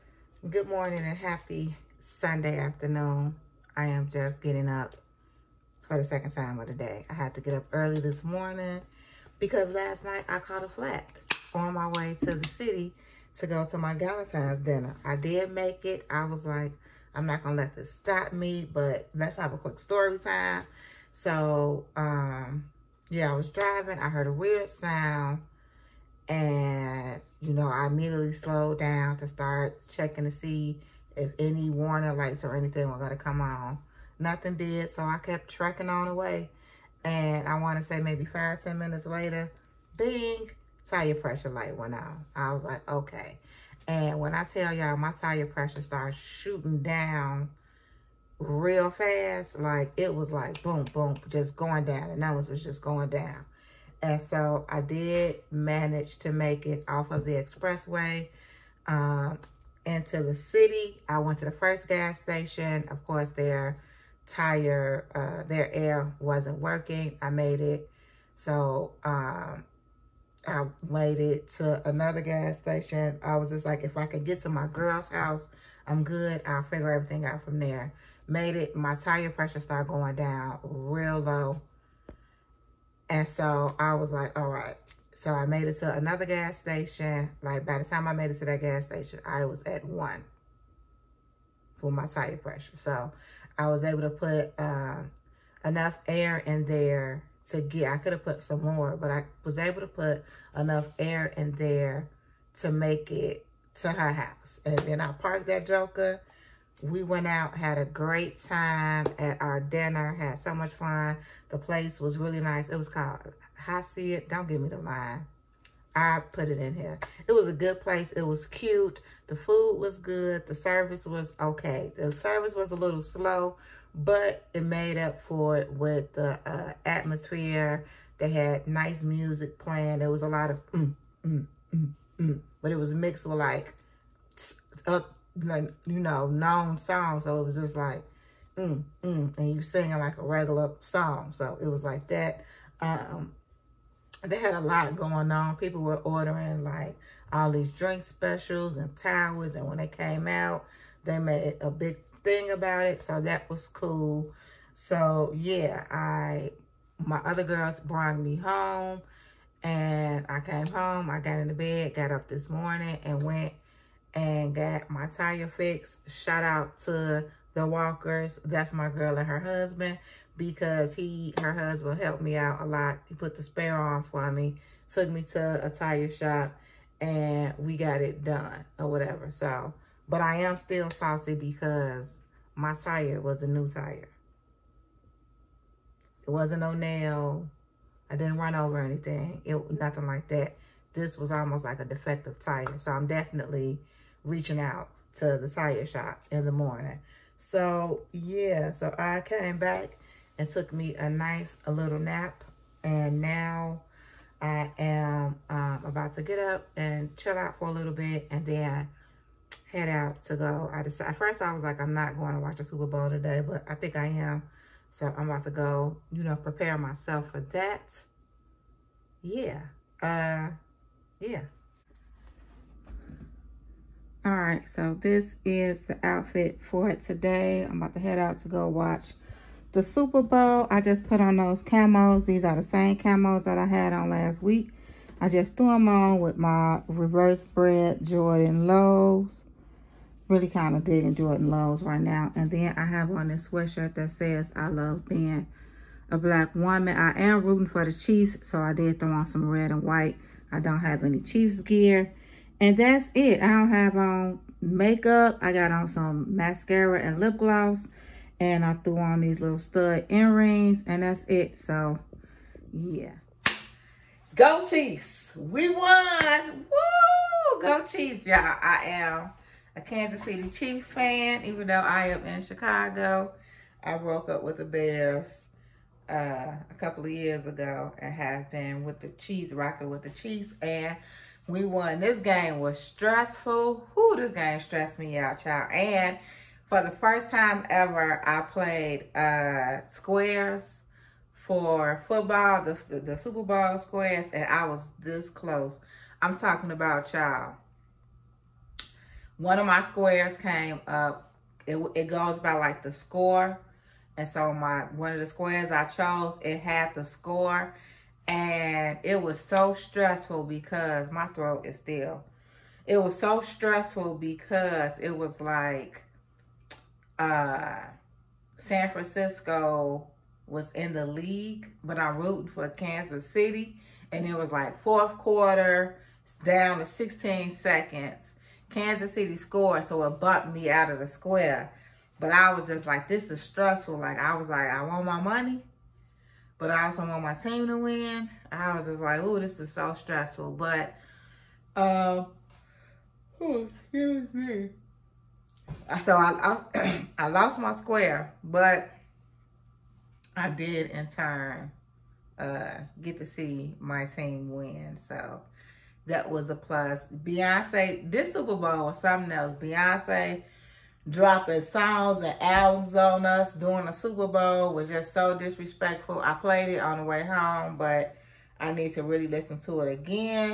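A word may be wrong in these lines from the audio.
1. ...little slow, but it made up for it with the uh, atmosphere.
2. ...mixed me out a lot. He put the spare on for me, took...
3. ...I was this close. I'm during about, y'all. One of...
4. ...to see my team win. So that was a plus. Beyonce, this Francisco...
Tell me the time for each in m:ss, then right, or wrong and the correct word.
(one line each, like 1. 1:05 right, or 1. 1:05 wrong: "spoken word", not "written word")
1. 2:02 right
2. 2:51 wrong: "helped", not "mixed"
3. 4:54 wrong: "talking", not "during"
4. 5:53 wrong: "Super", not "Francisco".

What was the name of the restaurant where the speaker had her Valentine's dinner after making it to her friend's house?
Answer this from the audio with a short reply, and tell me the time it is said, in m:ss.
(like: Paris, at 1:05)
Hacienda, at 1:53.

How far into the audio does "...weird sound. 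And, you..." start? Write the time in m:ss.
0:24.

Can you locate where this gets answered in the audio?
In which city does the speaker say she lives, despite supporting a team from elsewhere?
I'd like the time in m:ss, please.
4:32.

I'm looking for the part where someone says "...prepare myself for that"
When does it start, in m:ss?
3:36.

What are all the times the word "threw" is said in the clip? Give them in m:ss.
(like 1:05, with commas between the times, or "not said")
3:55, 4:18.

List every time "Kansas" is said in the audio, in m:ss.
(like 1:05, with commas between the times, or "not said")
4:29, 5:22, 5:28.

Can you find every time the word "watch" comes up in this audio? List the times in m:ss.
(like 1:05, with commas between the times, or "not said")
3:32, 3:48.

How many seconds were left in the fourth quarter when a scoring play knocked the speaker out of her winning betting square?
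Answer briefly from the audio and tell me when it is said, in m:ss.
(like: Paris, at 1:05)
16, at 5:26.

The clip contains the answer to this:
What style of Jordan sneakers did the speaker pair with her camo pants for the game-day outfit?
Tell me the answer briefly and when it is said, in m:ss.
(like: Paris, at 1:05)
Reverse bred Jordan lows, at 3:56.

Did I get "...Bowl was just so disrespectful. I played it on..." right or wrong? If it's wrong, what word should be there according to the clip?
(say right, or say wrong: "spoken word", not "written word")
right.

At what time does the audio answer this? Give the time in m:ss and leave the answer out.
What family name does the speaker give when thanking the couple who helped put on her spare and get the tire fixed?
2:47.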